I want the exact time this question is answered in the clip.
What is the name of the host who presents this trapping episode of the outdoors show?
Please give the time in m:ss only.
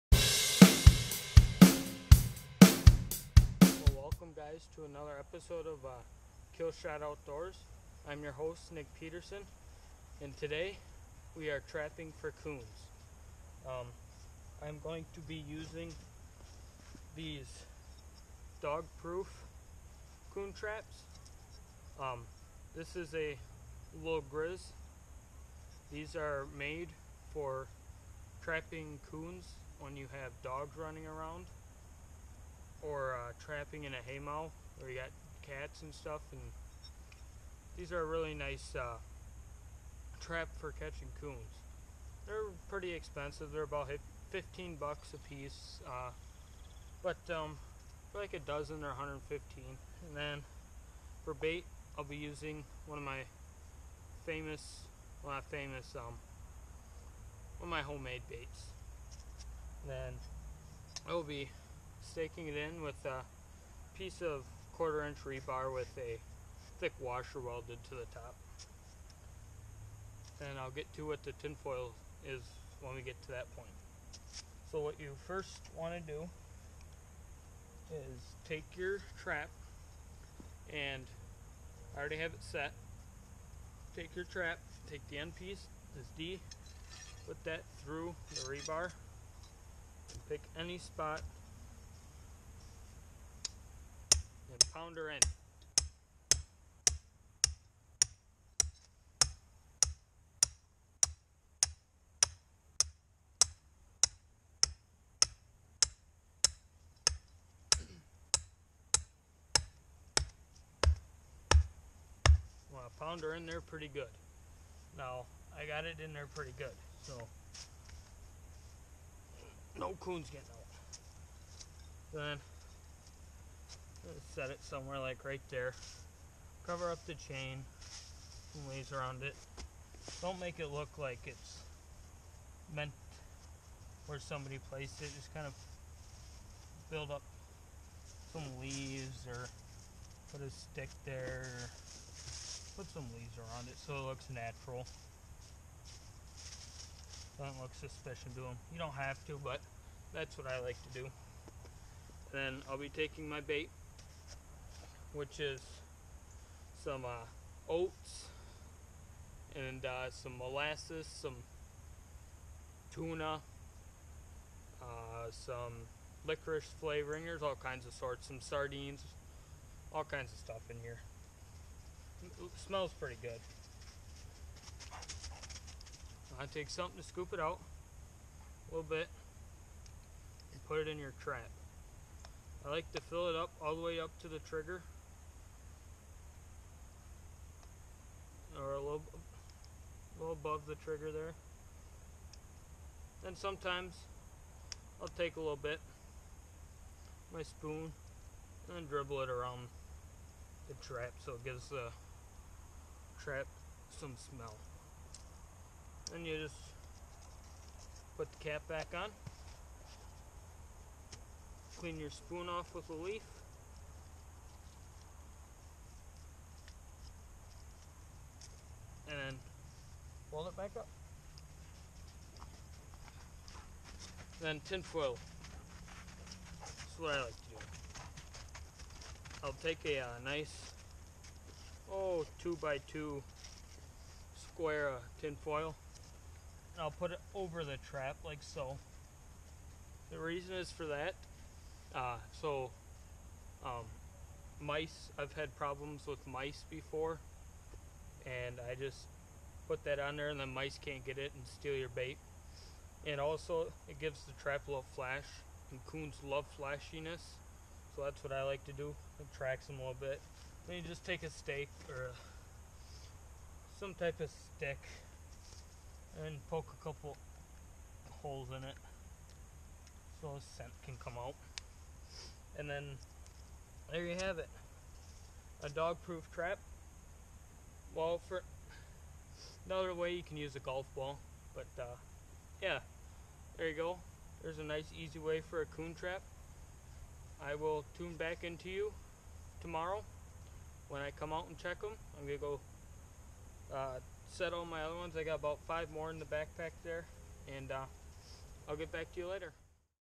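0:08.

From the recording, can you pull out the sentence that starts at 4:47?
I will tune back into you tomorrow when I come out and check them.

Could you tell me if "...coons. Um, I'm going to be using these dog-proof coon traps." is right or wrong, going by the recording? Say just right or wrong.
right.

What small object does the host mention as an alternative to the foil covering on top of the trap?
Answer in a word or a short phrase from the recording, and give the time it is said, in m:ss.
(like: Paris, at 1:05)
golf ball, at 4:40.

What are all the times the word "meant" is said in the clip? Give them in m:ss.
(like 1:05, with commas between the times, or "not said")
2:12.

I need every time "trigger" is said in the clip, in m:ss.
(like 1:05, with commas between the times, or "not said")
3:04, 3:10.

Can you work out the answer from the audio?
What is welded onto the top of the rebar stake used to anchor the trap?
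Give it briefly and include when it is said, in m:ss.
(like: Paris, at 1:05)
thick washer, at 1:06.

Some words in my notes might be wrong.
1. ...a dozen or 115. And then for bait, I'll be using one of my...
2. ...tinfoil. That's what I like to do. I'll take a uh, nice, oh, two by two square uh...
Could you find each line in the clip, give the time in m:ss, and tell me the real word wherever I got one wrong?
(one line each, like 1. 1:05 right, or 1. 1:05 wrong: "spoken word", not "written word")
1. 0:48 right
2. 3:44 right.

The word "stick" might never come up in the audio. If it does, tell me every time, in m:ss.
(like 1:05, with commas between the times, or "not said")
2:20, 4:24.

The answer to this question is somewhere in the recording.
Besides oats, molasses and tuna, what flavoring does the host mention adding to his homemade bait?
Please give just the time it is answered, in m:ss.
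2:46.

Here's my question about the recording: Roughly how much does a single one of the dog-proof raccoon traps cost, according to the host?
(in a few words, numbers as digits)
15 bucks.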